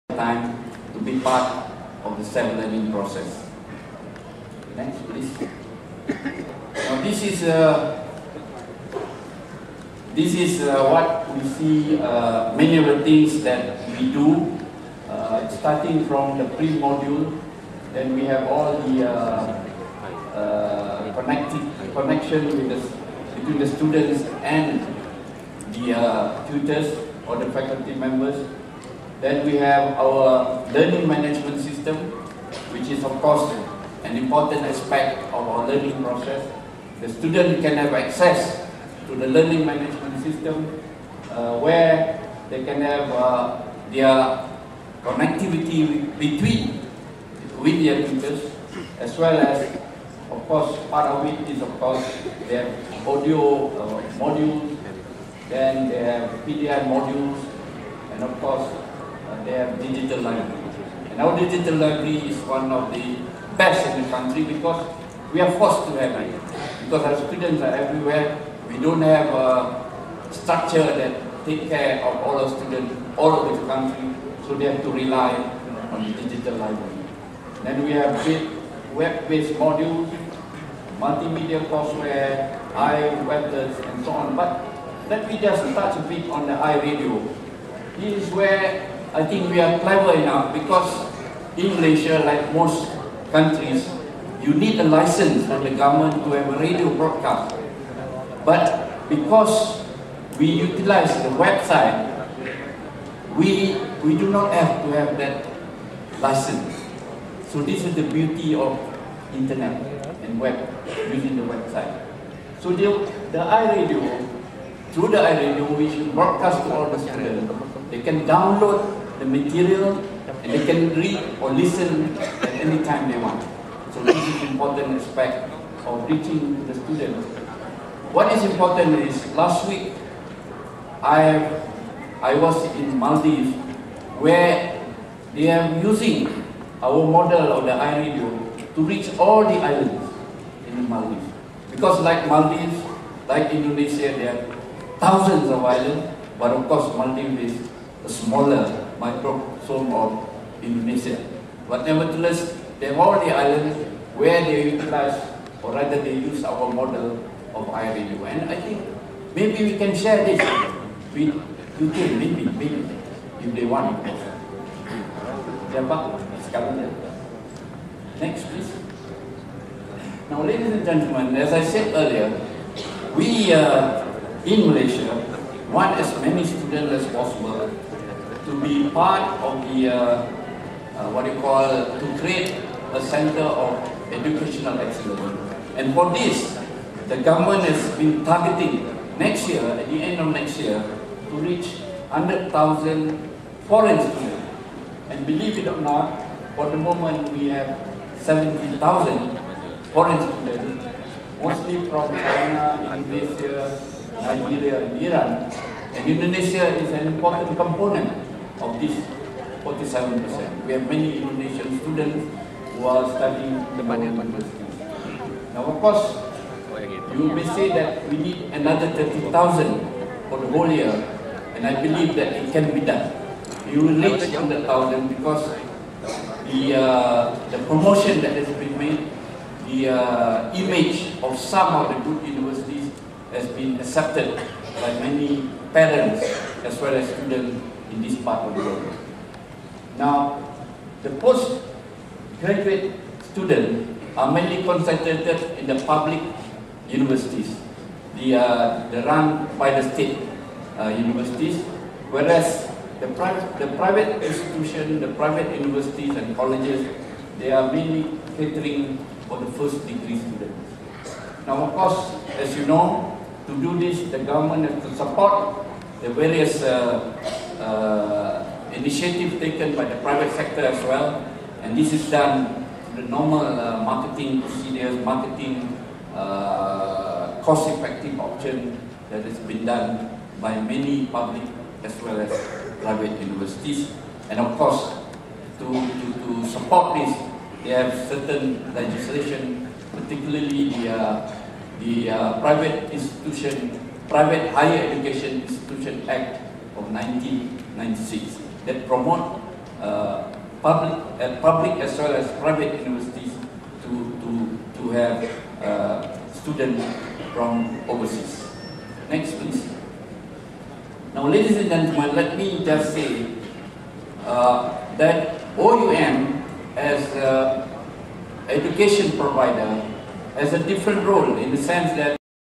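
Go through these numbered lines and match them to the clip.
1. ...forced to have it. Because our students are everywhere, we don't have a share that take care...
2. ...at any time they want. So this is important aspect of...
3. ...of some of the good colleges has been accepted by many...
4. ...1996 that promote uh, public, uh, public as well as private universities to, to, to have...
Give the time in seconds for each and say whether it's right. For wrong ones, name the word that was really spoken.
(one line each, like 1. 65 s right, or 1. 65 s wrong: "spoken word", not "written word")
1. 65 s wrong: "structure", not "share"
2. 122 s right
3. 231 s wrong: "universities", not "colleges"
4. 296 s right.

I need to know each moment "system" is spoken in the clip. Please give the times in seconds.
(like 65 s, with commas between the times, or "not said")
31 s, 40 s.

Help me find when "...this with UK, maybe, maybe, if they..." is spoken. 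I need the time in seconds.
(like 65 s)
160 s.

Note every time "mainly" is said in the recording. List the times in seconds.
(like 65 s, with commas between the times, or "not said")
244 s, 257 s.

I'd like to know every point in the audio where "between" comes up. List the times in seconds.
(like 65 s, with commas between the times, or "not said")
23 s, 46 s.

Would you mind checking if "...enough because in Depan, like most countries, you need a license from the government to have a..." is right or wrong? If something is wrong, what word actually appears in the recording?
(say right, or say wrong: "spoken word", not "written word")
wrong: "Malaysia", not "Depan".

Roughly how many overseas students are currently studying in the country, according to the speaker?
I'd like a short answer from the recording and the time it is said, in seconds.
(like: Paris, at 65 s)
70,000, at 198 s.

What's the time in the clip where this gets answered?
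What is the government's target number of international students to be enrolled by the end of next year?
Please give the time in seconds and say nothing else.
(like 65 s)
192 s.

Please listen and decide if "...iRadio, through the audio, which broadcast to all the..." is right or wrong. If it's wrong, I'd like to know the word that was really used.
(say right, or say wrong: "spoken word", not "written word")
wrong: "iRadio", not "audio".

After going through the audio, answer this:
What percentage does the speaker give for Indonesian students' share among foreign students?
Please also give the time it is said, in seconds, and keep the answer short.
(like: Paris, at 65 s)
47%, at 209 s.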